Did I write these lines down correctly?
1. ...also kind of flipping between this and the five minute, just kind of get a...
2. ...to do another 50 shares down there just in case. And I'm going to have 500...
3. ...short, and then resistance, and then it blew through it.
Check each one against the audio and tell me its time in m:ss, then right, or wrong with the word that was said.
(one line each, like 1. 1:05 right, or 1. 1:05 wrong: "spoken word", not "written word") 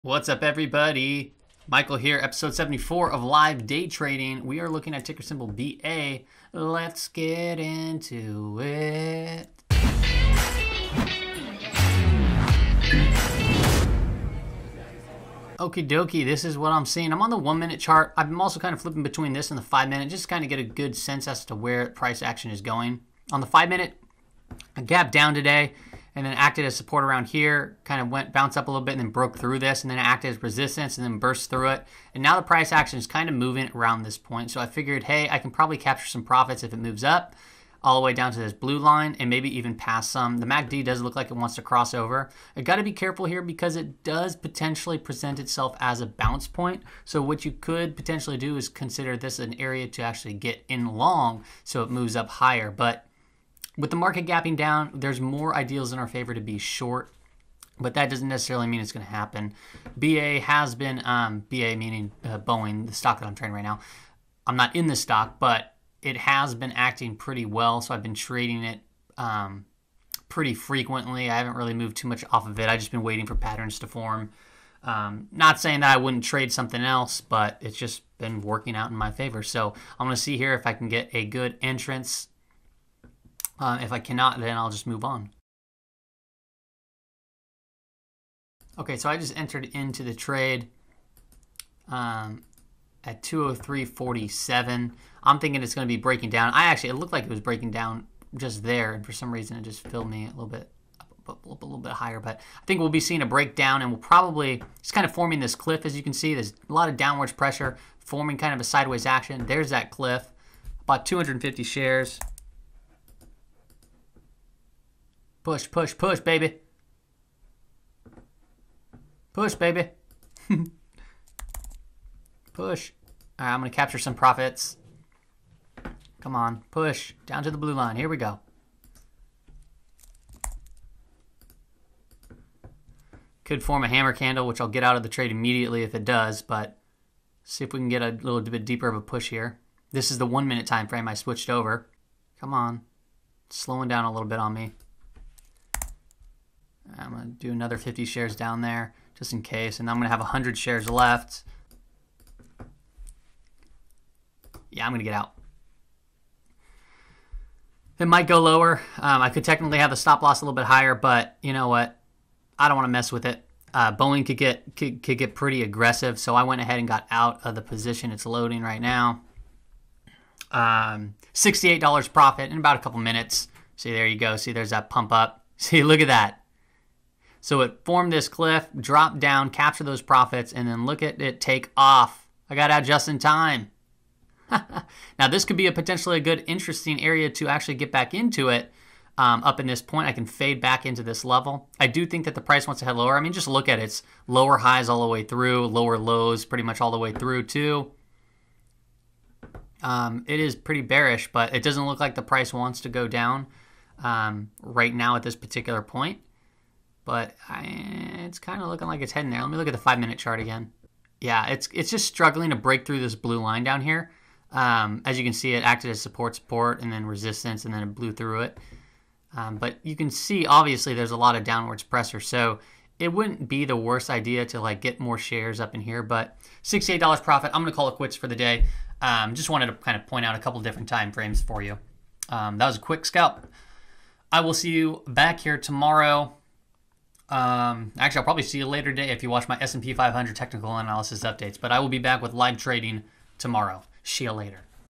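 1. 0:18 right
2. 2:27 wrong: "100", not "500"
3. 3:36 wrong: "support", not "short".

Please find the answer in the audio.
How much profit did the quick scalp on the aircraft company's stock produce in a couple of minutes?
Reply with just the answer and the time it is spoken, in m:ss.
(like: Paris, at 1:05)
$68, at 2:51.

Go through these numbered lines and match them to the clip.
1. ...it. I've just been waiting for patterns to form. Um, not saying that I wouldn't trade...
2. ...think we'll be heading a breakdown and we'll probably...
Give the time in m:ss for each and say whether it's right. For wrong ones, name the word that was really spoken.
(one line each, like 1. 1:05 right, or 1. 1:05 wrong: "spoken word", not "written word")
1. 1:12 right
2. 1:42 wrong: "seeing", not "heading".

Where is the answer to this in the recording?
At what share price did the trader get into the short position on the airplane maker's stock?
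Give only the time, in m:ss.
1:33.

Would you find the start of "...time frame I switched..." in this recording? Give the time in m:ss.
2:20.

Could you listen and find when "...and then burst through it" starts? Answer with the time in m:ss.
0:30.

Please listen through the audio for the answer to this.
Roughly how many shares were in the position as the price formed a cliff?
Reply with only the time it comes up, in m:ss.
1:51.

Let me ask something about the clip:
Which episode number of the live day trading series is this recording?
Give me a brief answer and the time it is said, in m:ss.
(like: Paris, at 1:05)
74, at 0:02.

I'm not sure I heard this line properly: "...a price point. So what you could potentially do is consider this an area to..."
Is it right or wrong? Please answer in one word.
wrong.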